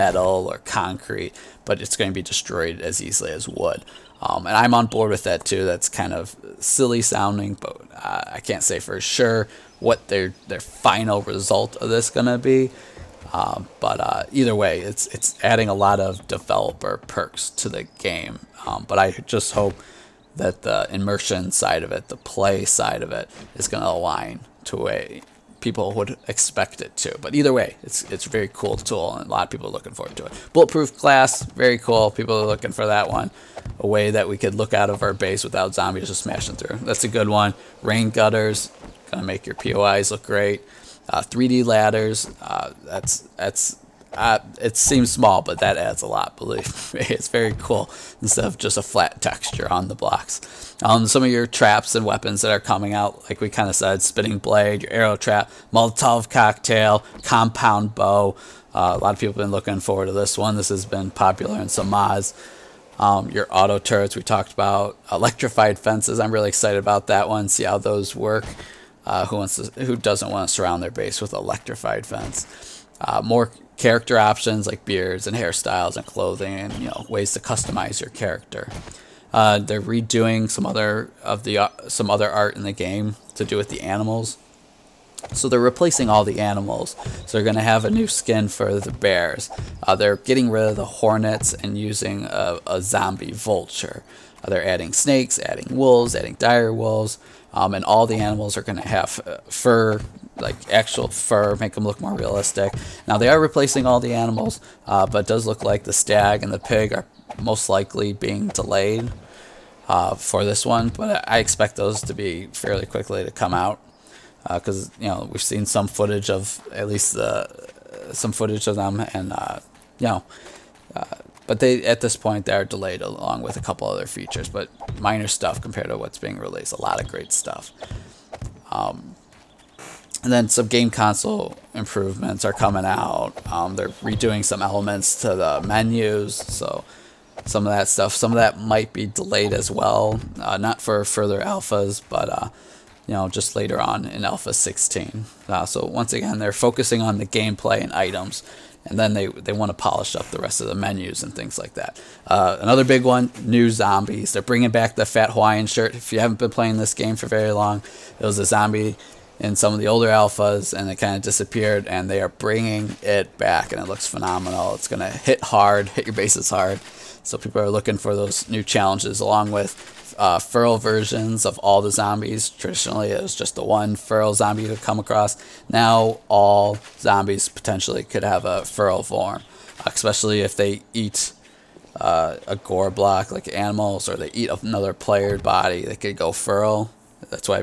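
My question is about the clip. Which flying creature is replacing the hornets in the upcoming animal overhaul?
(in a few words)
Zombie vulture.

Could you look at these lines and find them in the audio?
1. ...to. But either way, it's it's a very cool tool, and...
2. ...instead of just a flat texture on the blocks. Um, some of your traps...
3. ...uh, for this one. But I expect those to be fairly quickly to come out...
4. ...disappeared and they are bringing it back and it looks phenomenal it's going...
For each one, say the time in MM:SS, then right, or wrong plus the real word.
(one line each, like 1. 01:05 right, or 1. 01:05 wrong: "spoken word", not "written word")
1. 00:26 right
2. 00:48 right
3. 01:49 right
4. 02:41 right.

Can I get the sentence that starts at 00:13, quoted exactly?
Um, but uh, either way, it's it's adding a lot of developer perks to the game.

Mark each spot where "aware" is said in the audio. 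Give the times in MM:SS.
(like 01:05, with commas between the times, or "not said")
not said.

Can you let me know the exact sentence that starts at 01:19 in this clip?
Uh, they're redoing some other of the uh, some other art in the game to do with the animals.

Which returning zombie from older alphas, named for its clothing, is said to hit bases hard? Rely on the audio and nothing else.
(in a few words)
Fat Hawaiian shirt.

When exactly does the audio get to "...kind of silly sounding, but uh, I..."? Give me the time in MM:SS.
00:05.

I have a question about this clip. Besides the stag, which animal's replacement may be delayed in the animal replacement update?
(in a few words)
Pig.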